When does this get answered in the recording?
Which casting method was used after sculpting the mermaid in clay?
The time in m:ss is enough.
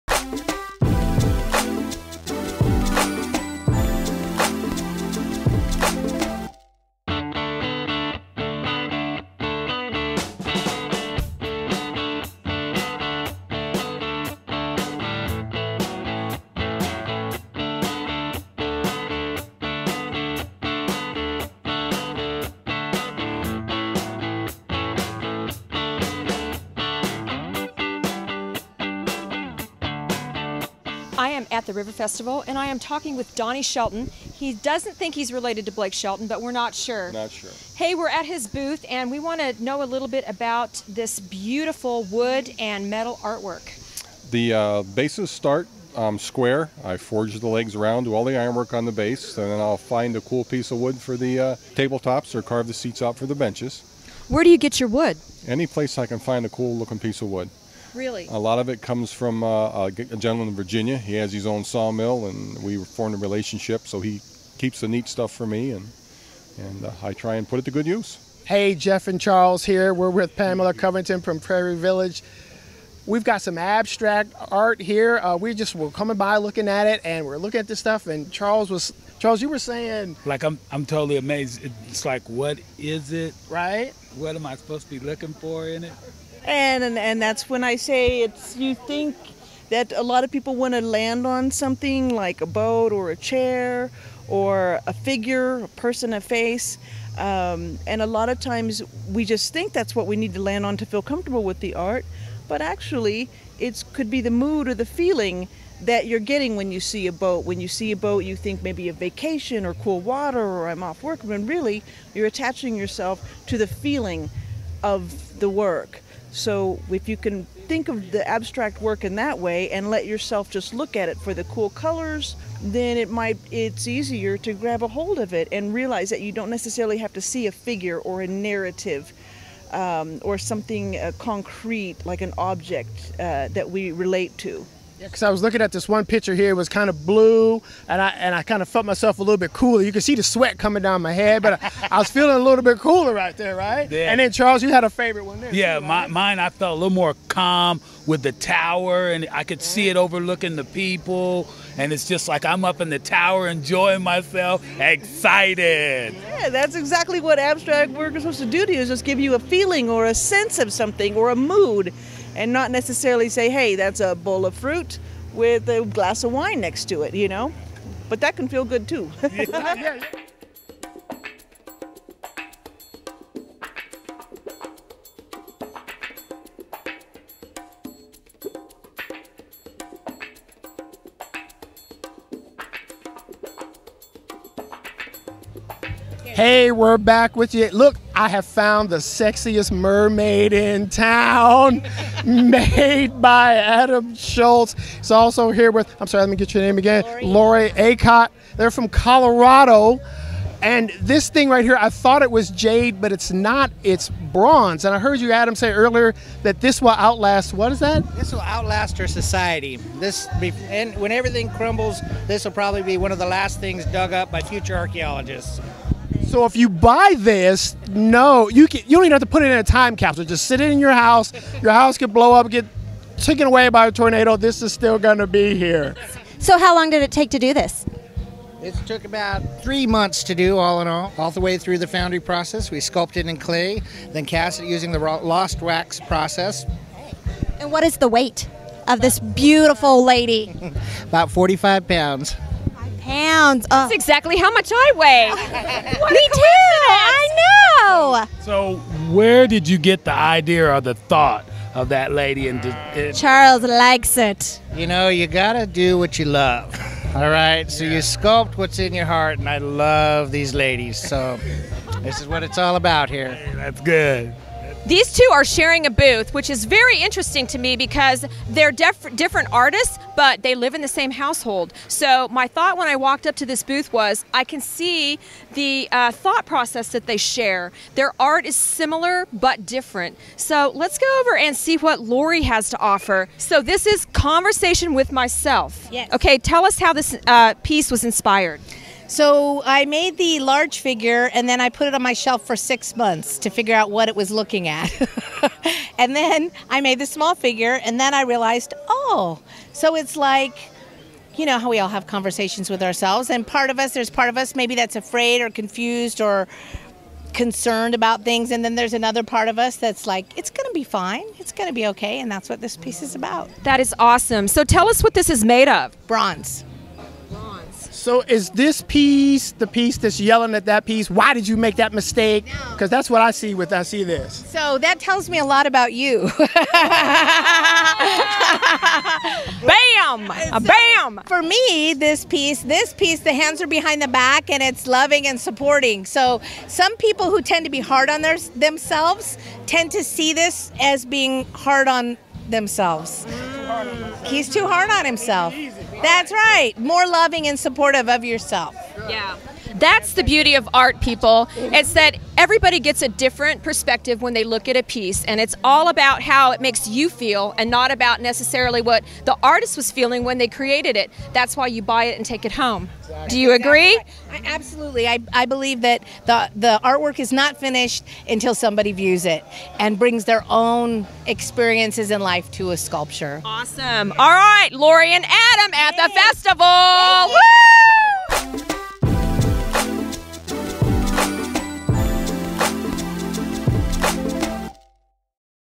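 3:54.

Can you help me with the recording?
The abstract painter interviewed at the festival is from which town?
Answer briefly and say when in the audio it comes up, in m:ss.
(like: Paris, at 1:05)
Prairie Village, at 1:11.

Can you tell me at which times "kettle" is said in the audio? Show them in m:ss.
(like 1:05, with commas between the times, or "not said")
not said.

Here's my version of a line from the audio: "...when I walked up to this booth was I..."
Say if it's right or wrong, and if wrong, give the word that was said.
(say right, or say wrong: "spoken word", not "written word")
right.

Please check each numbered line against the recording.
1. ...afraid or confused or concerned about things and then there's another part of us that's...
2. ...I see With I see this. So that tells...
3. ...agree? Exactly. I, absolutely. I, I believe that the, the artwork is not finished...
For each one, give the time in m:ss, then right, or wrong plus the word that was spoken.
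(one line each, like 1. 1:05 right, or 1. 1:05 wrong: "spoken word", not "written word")
1. 5:04 right
2. 5:23 right
3. 6:03 right.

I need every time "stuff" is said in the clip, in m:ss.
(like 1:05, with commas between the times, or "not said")
1:05, 1:17.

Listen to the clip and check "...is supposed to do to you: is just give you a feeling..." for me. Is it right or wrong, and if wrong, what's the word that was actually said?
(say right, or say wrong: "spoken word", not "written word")
right.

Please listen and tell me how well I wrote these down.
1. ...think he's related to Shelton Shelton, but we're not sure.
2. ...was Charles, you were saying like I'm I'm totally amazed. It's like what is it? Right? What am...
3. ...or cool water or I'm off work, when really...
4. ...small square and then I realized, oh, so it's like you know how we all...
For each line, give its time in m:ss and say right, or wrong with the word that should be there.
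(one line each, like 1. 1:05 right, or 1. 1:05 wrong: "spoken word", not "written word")
1. 0:34 wrong: "Blake", not "Shelton"
2. 1:18 right
3. 1:49 right
4. 4:57 wrong: "figure", not "square".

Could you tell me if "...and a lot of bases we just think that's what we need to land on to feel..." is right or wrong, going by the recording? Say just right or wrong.
wrong.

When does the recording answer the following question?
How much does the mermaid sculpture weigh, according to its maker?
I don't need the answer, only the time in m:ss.
4:01.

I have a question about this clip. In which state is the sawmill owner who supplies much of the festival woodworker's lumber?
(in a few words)
Virginia.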